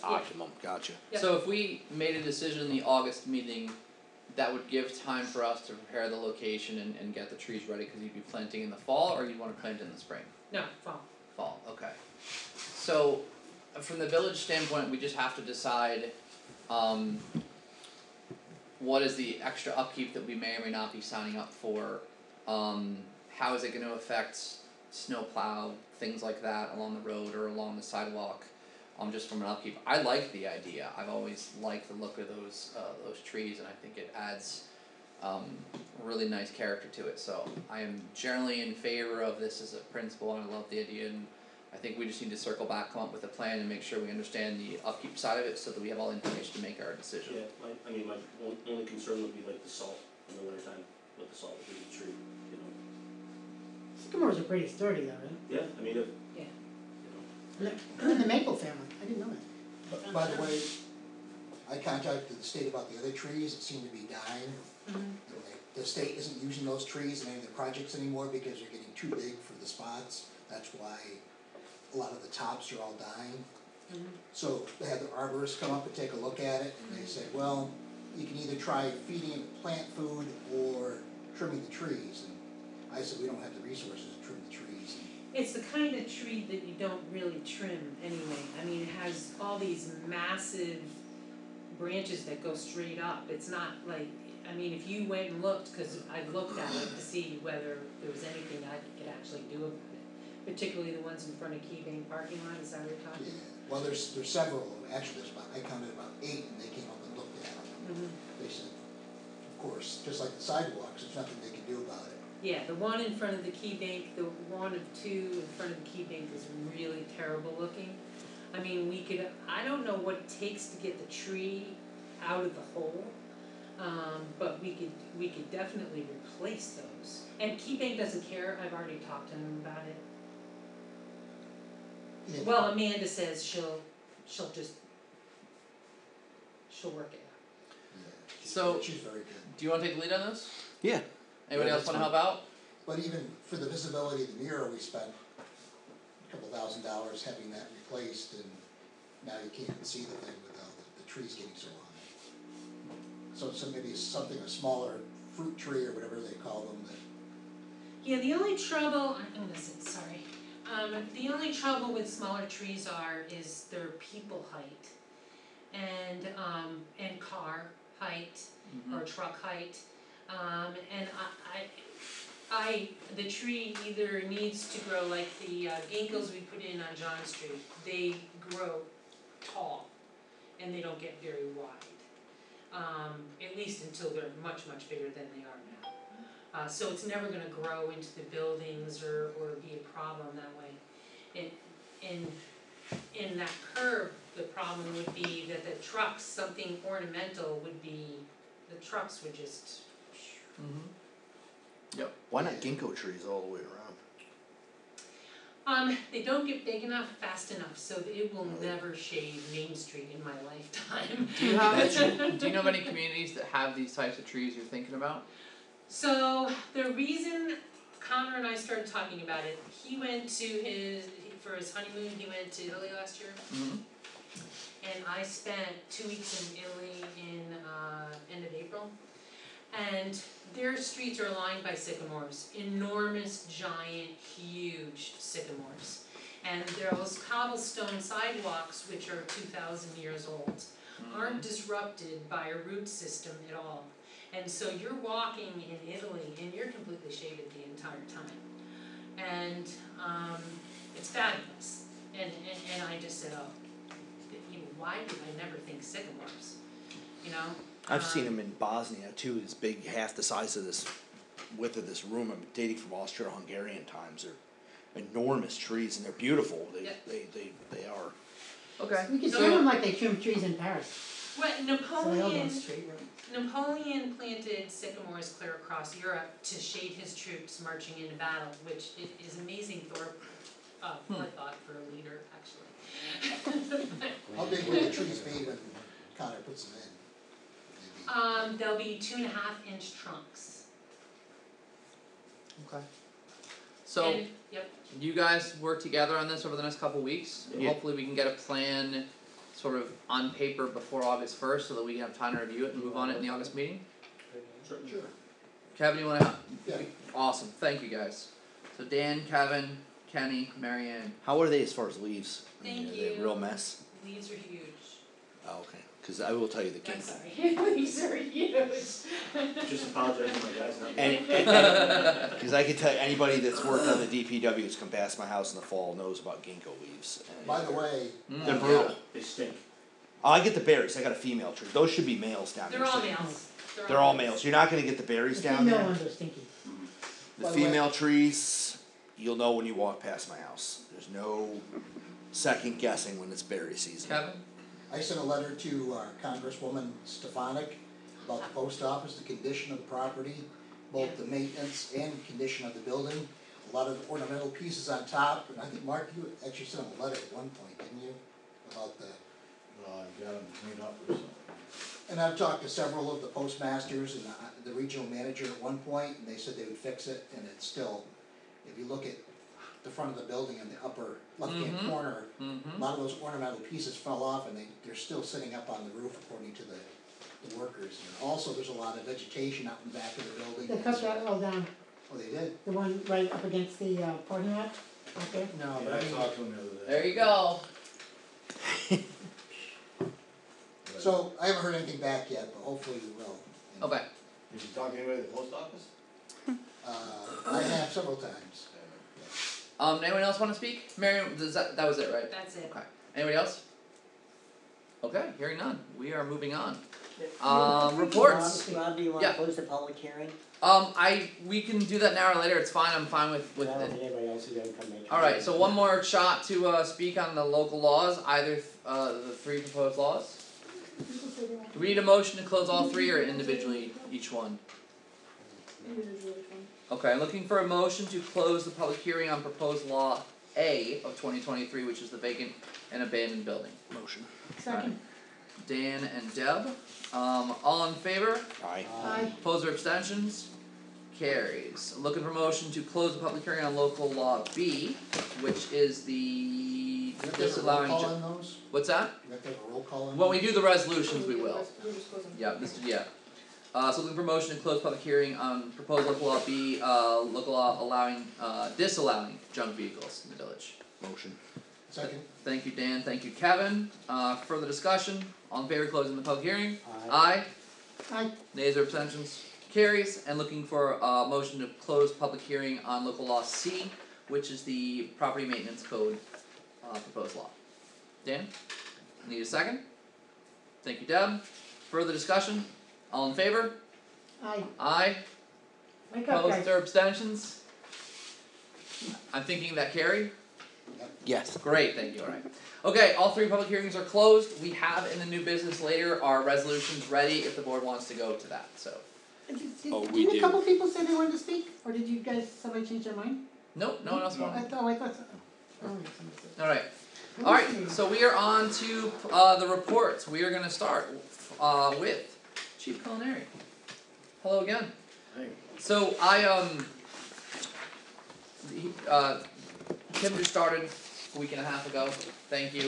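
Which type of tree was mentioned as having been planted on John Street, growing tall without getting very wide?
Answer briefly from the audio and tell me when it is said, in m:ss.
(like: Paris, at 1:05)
ginkgos, at 2:55.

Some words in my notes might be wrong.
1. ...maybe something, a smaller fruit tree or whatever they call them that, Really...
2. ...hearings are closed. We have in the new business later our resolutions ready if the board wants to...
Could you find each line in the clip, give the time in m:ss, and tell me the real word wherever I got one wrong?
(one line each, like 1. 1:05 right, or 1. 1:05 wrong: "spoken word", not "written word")
1. 2:33 wrong: "Yeah", not "Really"
2. 8:13 right.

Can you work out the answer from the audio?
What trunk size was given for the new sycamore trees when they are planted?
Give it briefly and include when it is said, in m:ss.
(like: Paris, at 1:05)
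2.5 inch trunks, at 4:49.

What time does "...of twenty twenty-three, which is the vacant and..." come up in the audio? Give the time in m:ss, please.
7:11.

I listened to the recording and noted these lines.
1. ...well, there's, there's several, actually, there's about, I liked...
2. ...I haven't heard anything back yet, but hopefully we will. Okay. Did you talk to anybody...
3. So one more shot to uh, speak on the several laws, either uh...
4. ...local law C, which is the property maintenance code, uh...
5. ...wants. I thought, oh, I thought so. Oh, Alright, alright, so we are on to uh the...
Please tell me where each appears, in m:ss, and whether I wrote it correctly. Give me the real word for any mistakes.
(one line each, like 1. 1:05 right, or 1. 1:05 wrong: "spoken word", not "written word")
1. 1:43 wrong: "counted", not "liked"
2. 6:31 right
3. 6:55 wrong: "local", not "several"
4. 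7:53 right
5. 8:24 right.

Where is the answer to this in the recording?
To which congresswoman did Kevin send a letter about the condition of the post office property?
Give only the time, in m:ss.
5:47.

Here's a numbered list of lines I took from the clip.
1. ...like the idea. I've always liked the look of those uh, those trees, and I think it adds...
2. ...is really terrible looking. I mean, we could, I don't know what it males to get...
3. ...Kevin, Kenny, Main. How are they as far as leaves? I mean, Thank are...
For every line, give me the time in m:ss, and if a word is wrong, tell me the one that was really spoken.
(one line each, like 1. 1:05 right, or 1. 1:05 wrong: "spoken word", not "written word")
1. 0:30 right
2. 1:56 wrong: "takes", not "males"
3. 5:09 wrong: "Marianne", not "Main".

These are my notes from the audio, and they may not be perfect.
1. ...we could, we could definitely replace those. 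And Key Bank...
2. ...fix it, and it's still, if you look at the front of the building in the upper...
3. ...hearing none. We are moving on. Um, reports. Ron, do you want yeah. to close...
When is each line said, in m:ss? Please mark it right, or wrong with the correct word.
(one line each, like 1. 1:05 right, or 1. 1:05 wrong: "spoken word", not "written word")
1. 2:04 right
2. 6:06 right
3. 6:45 right.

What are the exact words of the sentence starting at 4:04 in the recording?
And so you're walking in Italy and you're completely shaded the entire time.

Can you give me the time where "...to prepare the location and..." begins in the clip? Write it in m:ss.
0:05.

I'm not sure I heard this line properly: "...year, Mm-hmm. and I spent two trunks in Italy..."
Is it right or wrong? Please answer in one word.
wrong.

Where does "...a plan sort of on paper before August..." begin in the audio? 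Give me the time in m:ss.
4:58.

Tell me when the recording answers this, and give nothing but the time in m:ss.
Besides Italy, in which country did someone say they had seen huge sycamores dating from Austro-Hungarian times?
4:18.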